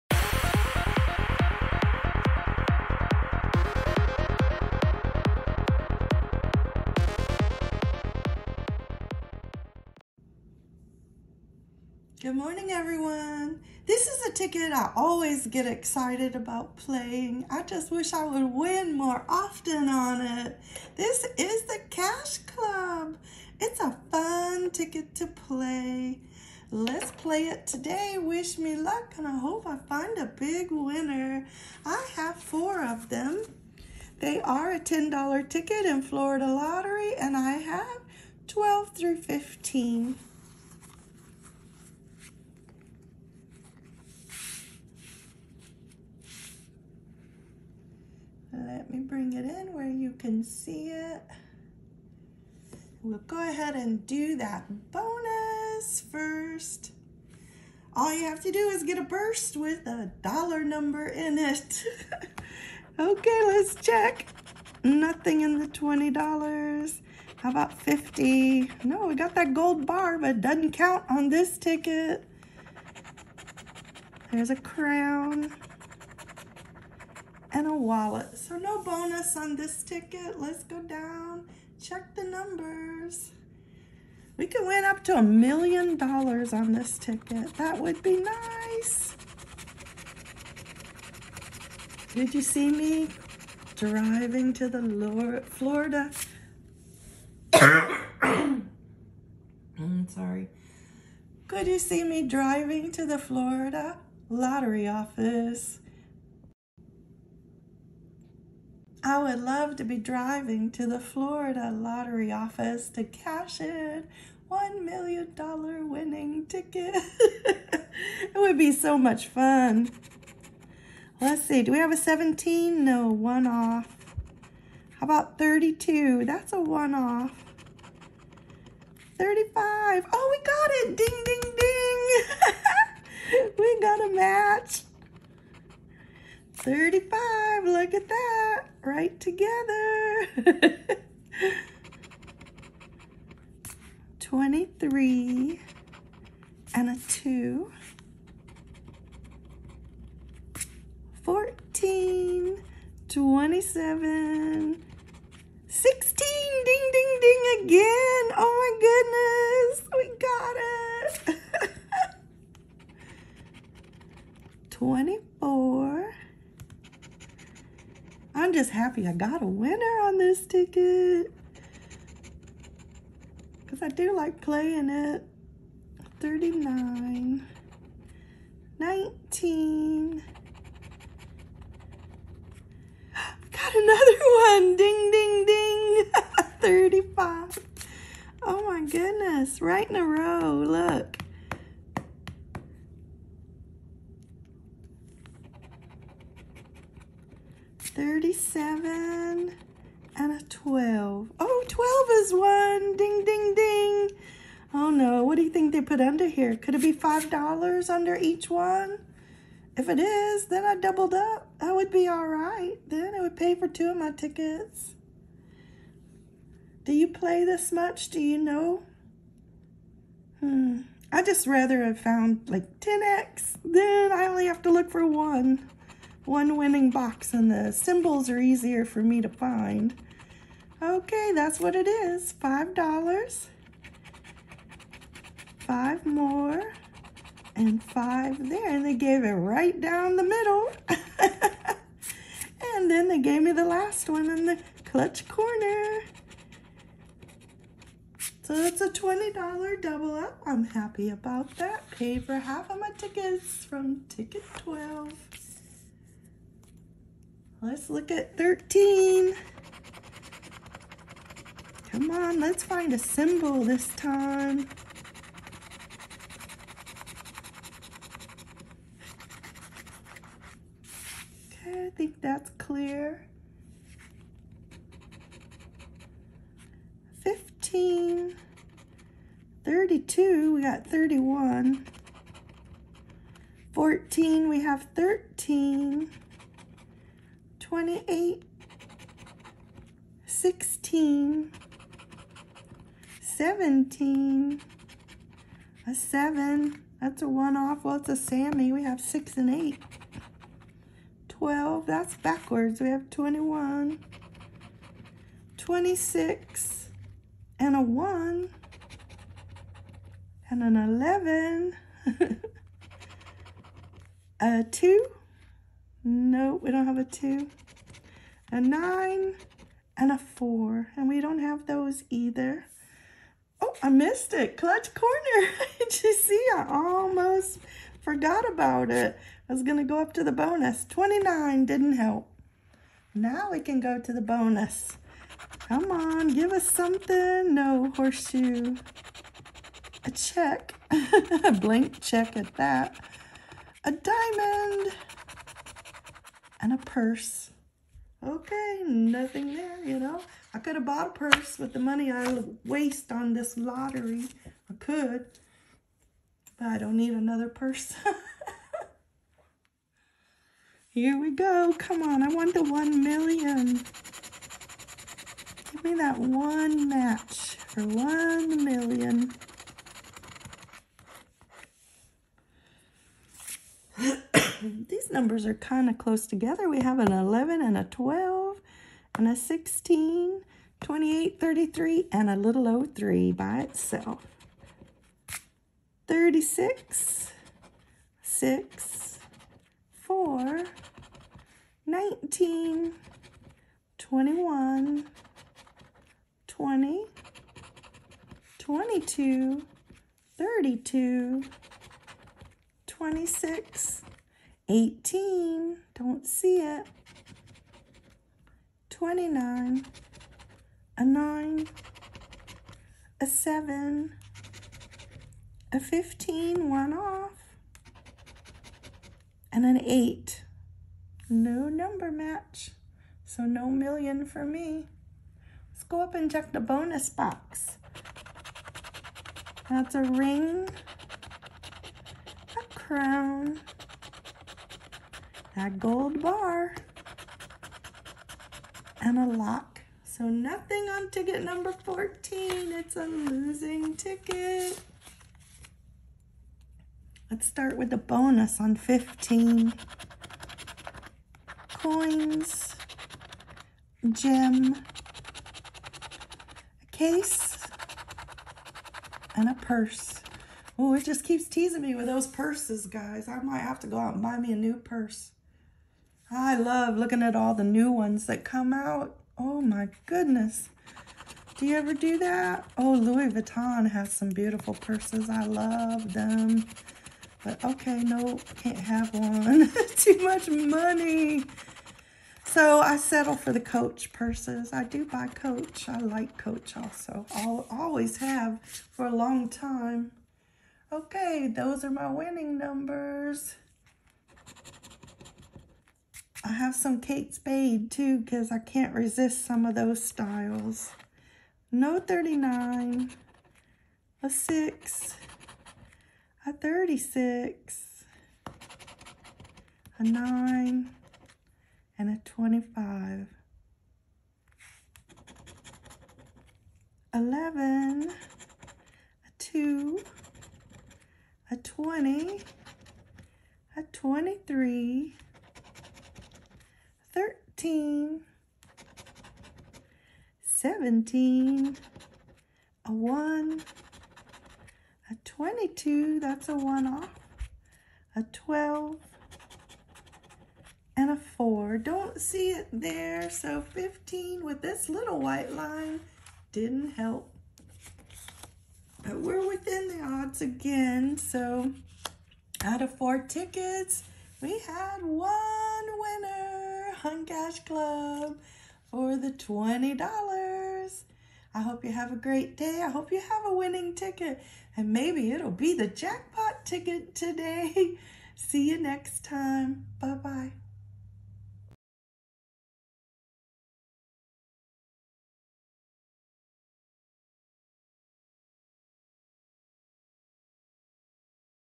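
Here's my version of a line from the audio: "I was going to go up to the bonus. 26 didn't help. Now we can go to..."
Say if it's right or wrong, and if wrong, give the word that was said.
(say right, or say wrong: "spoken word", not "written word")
wrong: "29", not "26".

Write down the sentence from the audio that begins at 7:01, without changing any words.
No number match, so no million for me.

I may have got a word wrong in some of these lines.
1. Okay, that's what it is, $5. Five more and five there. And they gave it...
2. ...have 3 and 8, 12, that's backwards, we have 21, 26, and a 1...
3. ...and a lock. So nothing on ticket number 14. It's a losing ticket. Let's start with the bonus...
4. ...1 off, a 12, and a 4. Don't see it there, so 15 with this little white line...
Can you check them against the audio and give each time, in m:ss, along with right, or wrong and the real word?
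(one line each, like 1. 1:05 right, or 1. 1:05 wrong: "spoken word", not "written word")
1. 3:50 right
2. 4:58 wrong: "6", not "3"
3. 7:19 right
4. 8:56 right.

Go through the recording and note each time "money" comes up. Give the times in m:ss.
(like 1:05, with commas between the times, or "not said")
5:51, 8:00.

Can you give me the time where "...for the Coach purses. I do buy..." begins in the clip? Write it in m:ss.
8:03.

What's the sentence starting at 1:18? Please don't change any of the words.
So no bonus on this ticket.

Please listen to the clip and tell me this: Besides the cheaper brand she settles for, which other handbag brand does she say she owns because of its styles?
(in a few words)
Kate Spade.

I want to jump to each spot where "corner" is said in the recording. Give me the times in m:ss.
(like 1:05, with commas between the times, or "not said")
4:05, 5:24.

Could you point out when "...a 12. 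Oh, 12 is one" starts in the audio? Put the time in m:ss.
3:20.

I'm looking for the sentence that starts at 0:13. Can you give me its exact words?
This is a ticket I always get excited about playing.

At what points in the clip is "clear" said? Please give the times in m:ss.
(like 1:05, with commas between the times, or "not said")
4:32.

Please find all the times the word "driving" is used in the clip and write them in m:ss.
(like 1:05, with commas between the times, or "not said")
1:33, 1:42, 1:49.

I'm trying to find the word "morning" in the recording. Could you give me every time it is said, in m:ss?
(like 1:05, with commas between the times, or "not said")
0:12.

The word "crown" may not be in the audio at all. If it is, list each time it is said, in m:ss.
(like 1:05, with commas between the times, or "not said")
1:14, 7:12.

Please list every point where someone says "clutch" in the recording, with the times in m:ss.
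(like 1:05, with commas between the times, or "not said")
4:04, 5:24.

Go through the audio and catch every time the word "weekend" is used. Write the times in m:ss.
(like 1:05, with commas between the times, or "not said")
not said.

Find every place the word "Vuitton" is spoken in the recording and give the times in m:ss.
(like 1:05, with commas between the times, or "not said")
7:53.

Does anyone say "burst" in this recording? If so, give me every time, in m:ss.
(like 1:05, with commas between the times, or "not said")
0:59.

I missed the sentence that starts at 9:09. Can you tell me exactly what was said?
But we're within the odds again, so out of four tickets, we had one.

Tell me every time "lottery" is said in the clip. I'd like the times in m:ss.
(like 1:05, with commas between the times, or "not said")
0:36, 1:44, 1:51, 5:53.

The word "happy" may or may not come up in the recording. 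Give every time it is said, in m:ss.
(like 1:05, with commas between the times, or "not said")
2:48, 4:10.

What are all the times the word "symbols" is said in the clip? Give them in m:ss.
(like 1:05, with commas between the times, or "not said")
3:47, 4:22.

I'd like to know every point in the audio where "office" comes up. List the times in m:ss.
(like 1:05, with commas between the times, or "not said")
1:44, 1:52.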